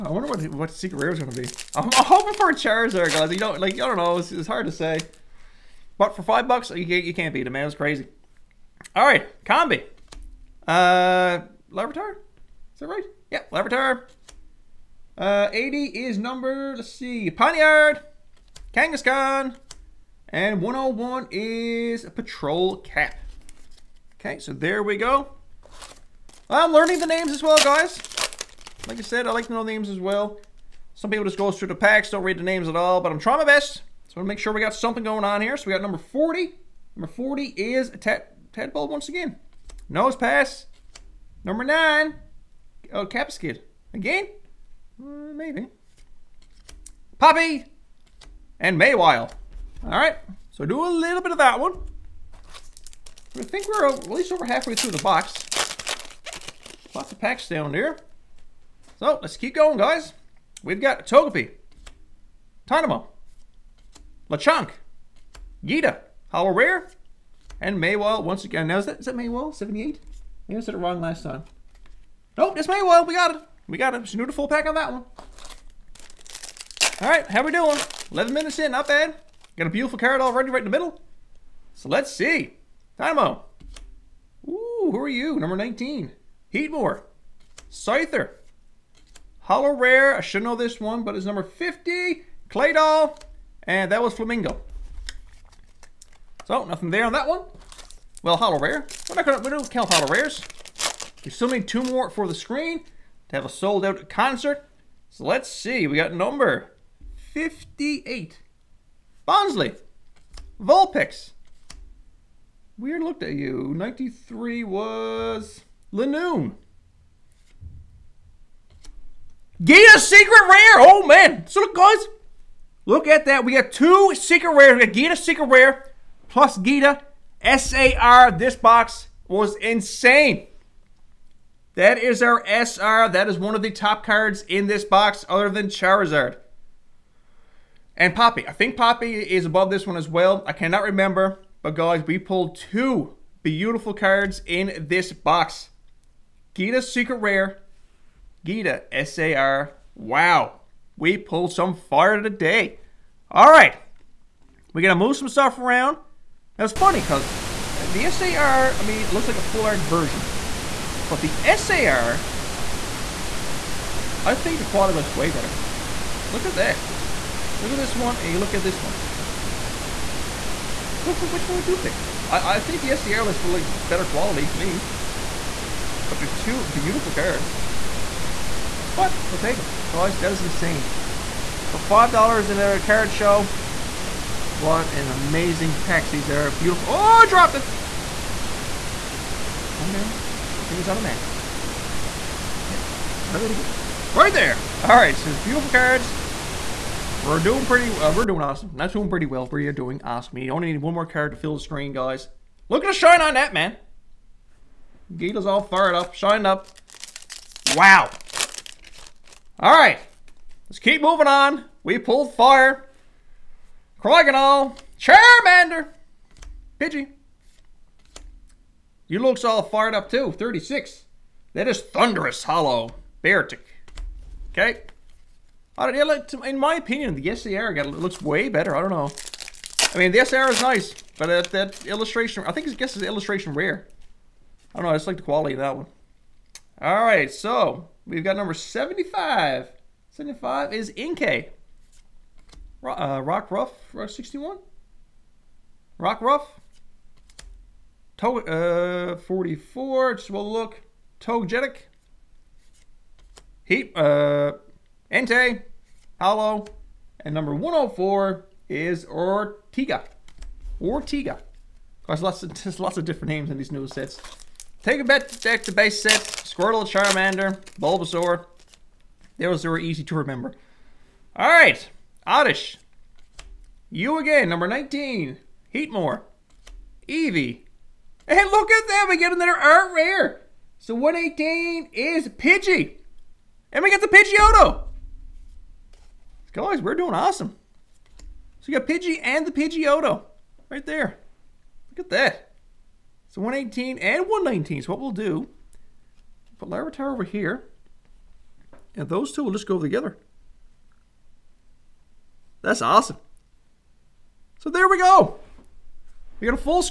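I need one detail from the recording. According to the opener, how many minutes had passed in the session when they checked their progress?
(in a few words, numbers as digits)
11.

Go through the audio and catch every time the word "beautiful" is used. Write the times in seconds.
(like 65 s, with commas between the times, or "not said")
79 s, 143 s, 176 s, 186 s, 195 s.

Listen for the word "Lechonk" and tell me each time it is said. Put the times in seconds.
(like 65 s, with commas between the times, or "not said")
64 s.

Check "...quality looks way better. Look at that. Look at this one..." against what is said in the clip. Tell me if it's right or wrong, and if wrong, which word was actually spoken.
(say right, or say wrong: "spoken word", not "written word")
right.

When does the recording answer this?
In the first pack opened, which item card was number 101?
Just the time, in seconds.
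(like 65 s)
22 s.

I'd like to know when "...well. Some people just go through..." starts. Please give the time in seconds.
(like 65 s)
30 s.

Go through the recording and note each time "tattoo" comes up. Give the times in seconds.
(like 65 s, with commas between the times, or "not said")
not said.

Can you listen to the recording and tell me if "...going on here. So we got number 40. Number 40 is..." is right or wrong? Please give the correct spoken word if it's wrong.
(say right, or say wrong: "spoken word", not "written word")
right.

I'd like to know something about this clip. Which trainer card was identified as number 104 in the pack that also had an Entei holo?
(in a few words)
Ortiga.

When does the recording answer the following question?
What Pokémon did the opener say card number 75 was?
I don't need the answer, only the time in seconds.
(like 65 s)
240 s.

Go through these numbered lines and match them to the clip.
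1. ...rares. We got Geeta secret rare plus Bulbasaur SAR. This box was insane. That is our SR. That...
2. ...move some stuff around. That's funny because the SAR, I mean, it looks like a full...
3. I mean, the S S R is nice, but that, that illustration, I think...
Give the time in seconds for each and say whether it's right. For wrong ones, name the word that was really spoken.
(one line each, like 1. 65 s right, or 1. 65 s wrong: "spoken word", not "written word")
1. 124 s wrong: "Geeta", not "Bulbasaur"
2. 155 s right
3. 229 s right.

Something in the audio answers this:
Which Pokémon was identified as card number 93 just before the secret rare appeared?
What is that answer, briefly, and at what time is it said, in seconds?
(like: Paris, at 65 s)
Linoone, at 115 s.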